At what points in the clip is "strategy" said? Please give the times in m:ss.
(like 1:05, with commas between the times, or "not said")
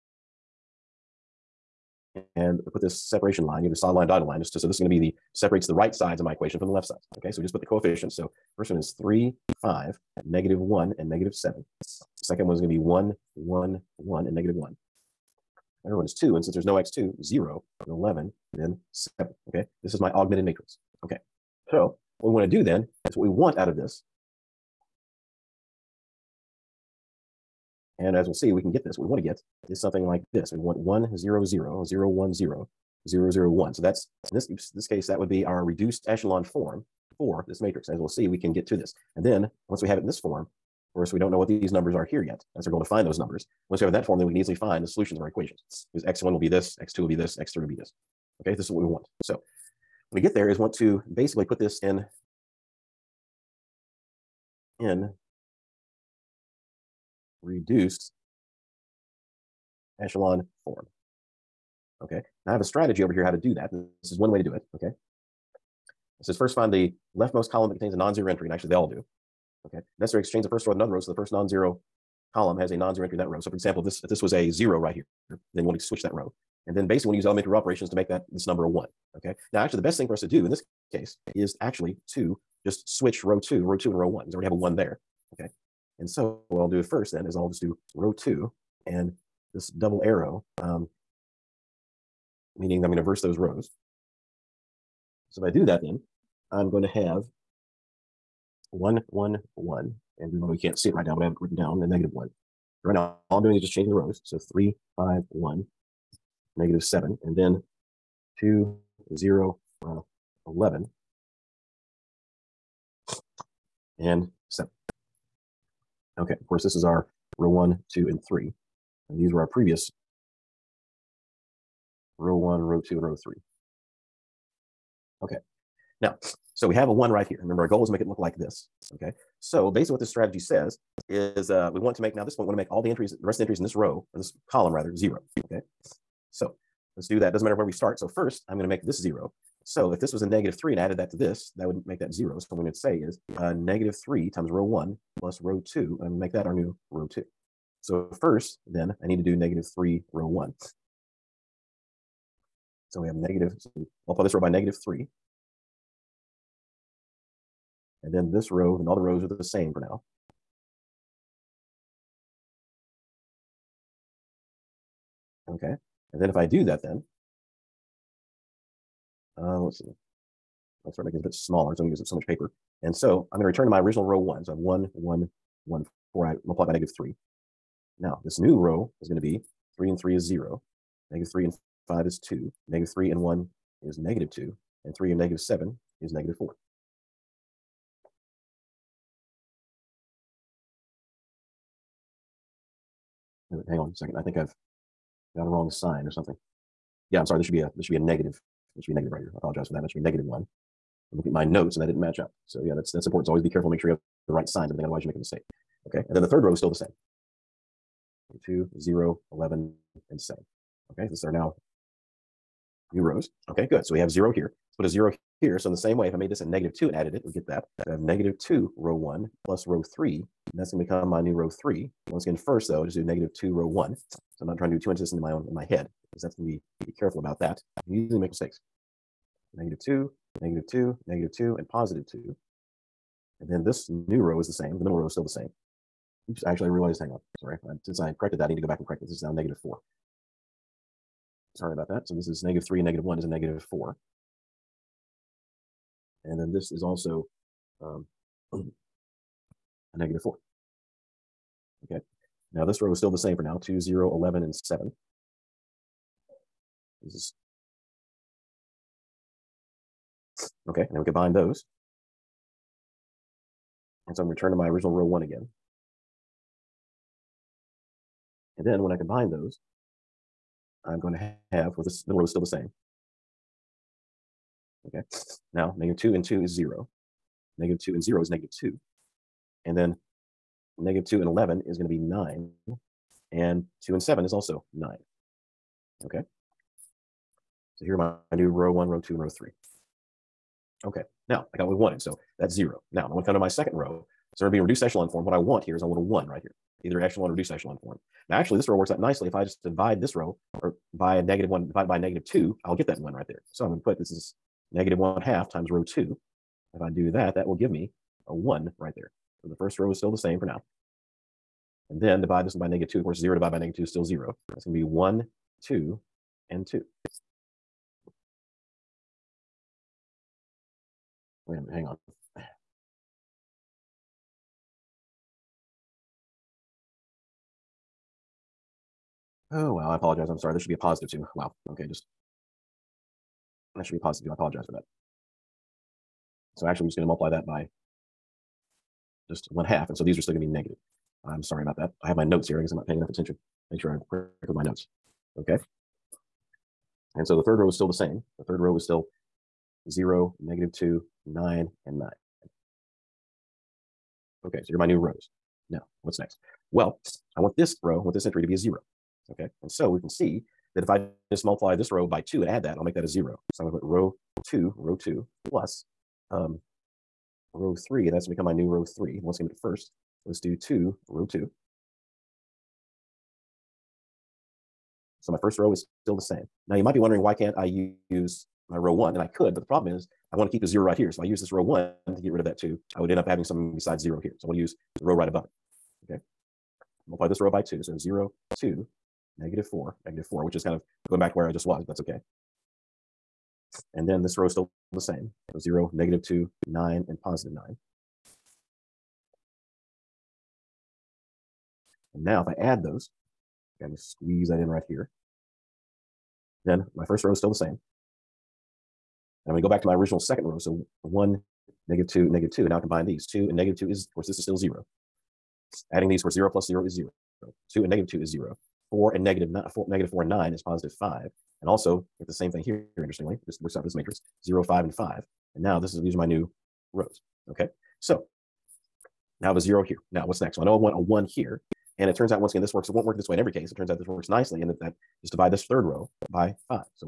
1:02, 2:10.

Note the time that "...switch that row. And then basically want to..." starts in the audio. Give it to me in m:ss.
1:15.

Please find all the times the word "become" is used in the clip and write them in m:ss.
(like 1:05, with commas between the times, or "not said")
3:40, 6:08.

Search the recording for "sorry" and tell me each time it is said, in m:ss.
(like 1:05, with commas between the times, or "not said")
3:17, 3:57, 4:01, 5:30, 5:41.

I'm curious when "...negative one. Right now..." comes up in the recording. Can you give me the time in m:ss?
1:41.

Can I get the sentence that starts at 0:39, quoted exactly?
And then once we have it in this form, of course, we don't know what these numbers are here yet.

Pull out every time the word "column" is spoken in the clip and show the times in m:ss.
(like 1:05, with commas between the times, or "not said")
1:07, 1:12, 2:14.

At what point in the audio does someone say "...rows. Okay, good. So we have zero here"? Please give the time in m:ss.
3:33.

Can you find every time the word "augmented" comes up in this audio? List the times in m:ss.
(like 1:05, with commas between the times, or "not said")
0:20.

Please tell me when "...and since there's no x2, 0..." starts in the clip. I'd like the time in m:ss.
0:16.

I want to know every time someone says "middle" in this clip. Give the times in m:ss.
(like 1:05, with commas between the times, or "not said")
3:54, 4:32.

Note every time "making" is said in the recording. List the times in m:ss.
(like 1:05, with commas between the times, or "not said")
2:51.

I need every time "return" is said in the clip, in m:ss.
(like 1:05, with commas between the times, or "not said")
2:53, 4:24.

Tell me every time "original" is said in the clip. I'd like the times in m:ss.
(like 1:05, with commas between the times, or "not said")
2:53, 4:24, 6:49.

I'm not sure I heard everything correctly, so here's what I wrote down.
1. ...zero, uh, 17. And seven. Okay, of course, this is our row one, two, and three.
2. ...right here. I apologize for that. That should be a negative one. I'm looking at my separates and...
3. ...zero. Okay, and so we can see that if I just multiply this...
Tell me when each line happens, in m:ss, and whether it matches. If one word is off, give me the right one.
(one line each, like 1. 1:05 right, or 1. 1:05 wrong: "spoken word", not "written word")
1. 1:49 wrong: "11", not "17"
2. 3:19 wrong: "notes", not "separates"
3. 5:58 right.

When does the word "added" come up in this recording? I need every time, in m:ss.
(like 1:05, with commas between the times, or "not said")
2:20, 3:36.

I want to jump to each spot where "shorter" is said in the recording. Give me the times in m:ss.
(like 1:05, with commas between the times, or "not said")
not said.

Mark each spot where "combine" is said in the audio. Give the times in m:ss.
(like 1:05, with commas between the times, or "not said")
4:21, 4:28, 6:52.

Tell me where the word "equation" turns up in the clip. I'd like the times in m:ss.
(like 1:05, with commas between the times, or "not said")
0:06, 0:45.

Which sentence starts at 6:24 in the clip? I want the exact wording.
So I want to use the row right above it, okay?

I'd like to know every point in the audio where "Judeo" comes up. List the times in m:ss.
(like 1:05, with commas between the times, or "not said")
not said.